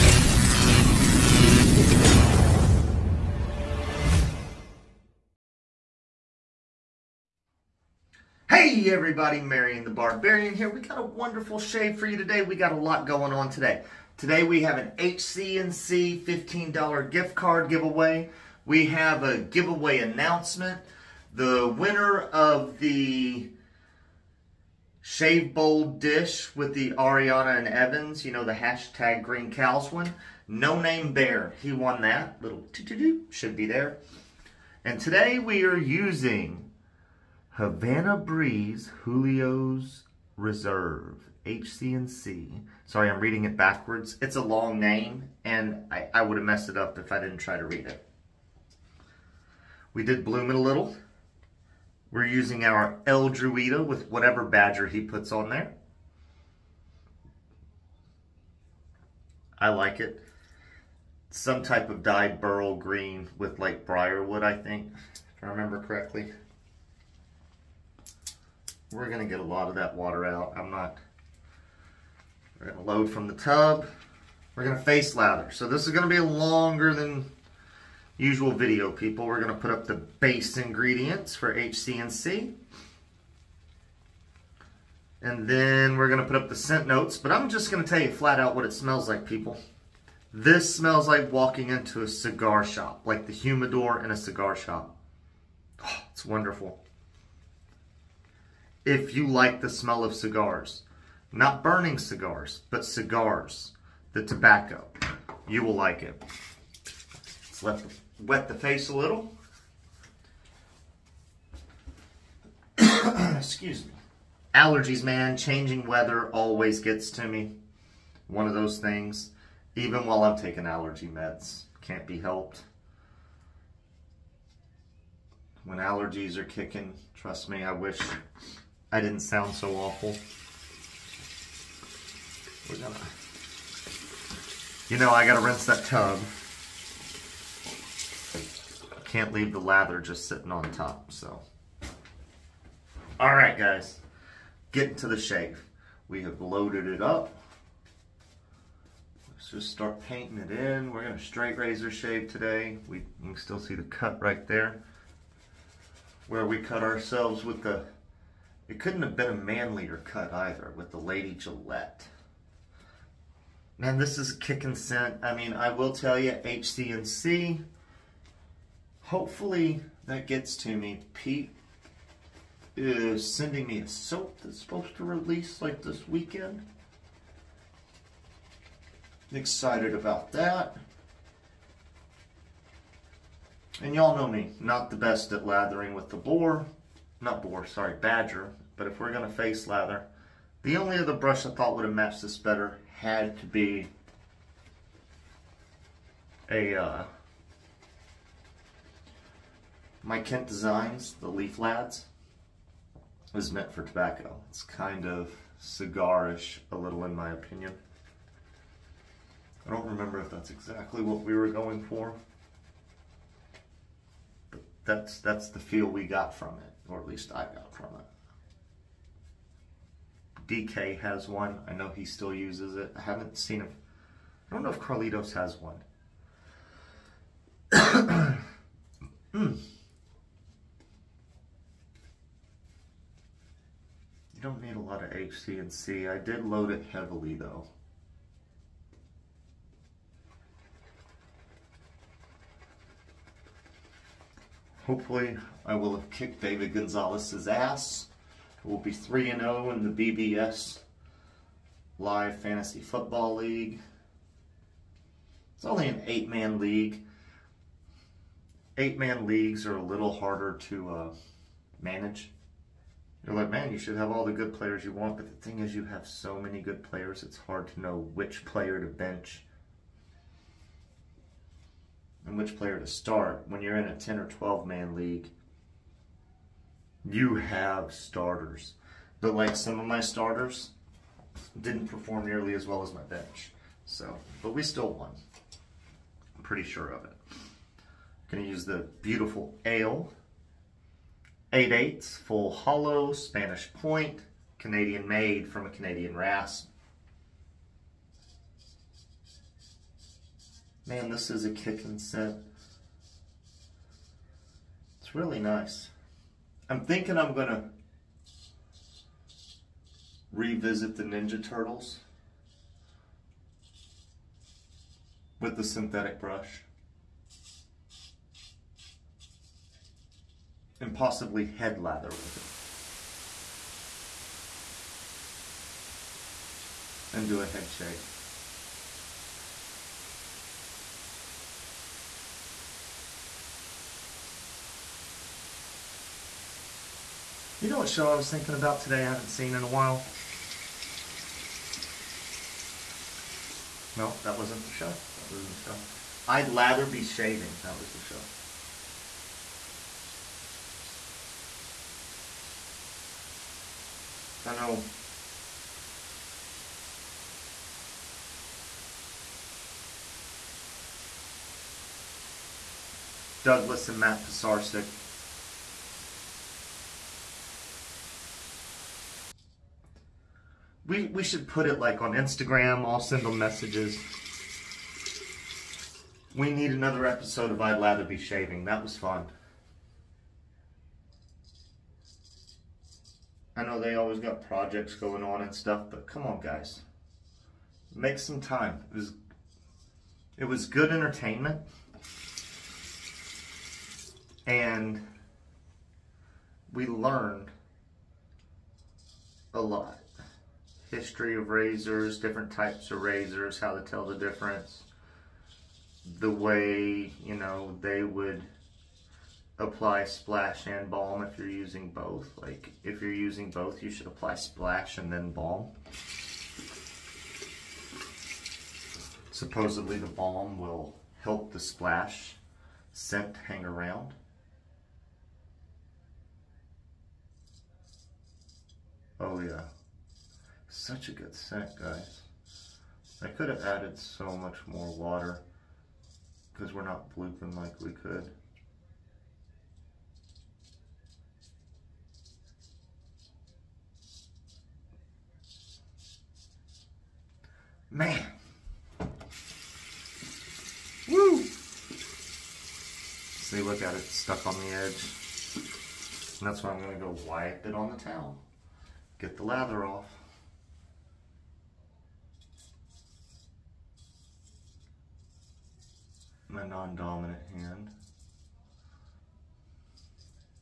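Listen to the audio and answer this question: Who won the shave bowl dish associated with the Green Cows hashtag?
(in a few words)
No Name Bear.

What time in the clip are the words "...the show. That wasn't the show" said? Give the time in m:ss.
5:44.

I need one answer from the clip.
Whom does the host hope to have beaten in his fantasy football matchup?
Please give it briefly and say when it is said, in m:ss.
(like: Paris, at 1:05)
David Gonzalez, at 4:06.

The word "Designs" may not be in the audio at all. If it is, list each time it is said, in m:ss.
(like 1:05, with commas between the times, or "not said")
3:20.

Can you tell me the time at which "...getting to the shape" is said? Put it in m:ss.
2:24.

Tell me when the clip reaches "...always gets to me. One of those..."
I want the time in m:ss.
1:56.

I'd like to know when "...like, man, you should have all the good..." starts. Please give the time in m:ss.
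4:23.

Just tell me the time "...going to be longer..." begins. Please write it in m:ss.
1:15.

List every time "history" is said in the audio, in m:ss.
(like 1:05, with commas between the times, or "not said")
6:40.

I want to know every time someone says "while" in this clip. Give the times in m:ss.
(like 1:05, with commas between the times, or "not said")
2:00, 5:39.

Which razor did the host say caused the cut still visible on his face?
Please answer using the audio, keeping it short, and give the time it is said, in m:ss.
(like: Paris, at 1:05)
Lady Gillette, at 2:40.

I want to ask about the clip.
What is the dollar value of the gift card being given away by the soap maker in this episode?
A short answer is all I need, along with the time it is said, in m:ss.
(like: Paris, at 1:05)
$15, at 0:16.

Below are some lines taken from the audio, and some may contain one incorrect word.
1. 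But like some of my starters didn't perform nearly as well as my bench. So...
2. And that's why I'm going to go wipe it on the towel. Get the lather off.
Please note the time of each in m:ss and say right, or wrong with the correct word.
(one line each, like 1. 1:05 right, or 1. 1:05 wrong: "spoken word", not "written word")
1. 4:39 right
2. 7:36 right.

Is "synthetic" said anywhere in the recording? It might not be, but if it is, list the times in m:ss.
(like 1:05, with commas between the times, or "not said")
5:15.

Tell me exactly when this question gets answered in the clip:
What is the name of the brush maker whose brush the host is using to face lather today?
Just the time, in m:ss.
0:53.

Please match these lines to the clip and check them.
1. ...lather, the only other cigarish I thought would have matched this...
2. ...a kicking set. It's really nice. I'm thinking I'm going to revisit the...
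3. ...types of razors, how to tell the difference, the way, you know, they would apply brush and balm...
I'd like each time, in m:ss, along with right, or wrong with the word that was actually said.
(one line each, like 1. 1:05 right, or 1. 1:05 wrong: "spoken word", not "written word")
1. 3:09 wrong: "brush", not "cigarish"
2. 5:01 right
3. 6:42 wrong: "splash", not "brush".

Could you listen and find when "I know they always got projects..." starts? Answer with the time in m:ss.
6:23.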